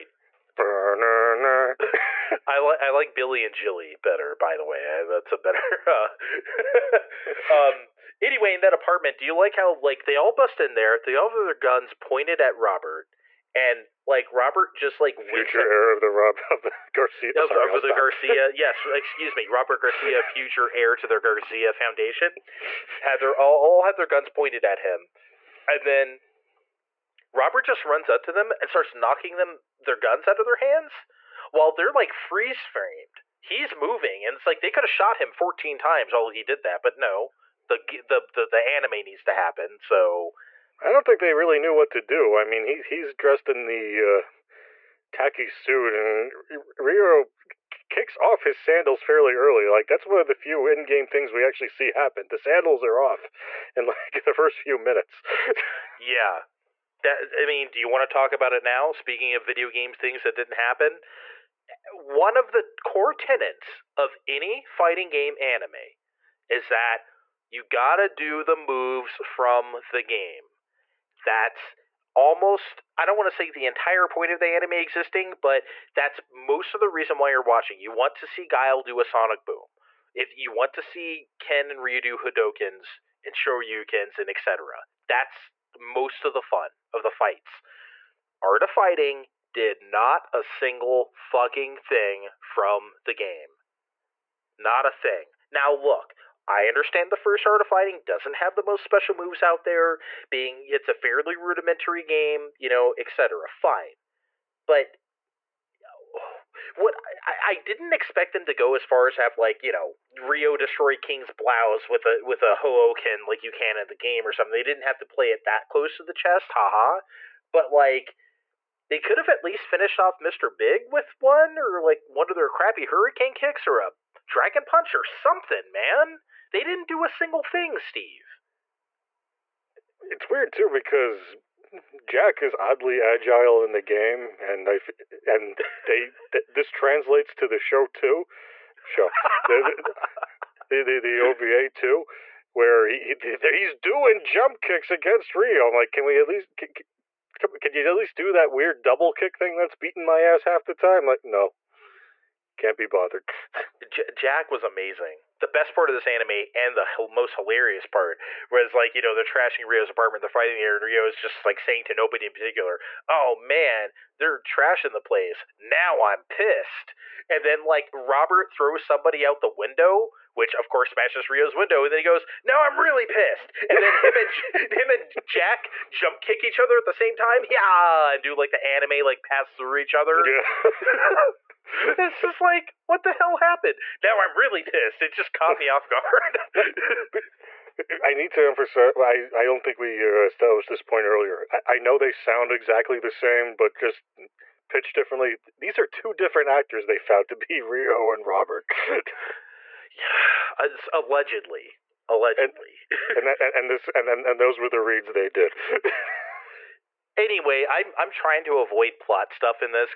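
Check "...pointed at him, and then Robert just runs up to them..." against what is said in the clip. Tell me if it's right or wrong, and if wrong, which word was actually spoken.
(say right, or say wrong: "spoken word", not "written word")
right.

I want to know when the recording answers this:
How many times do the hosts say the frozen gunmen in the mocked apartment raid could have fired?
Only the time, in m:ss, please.
0:35.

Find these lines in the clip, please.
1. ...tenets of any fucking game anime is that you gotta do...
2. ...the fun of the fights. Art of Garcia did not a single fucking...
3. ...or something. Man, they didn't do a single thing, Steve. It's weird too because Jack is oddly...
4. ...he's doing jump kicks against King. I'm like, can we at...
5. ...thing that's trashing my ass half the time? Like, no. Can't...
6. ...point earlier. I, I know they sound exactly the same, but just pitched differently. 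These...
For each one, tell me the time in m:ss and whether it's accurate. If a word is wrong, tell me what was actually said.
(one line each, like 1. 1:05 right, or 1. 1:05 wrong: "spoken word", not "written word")
1. 1:03 wrong: "fighting", not "fucking"
2. 1:26 wrong: "Fighting", not "Garcia"
3. 2:04 right
4. 2:23 wrong: "Ryo", not "King"
5. 2:29 wrong: "beating", not "trashing"
6. 3:10 right.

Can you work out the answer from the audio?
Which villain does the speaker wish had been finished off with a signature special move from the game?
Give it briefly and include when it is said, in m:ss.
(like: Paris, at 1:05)
Mister Big, at 2:00.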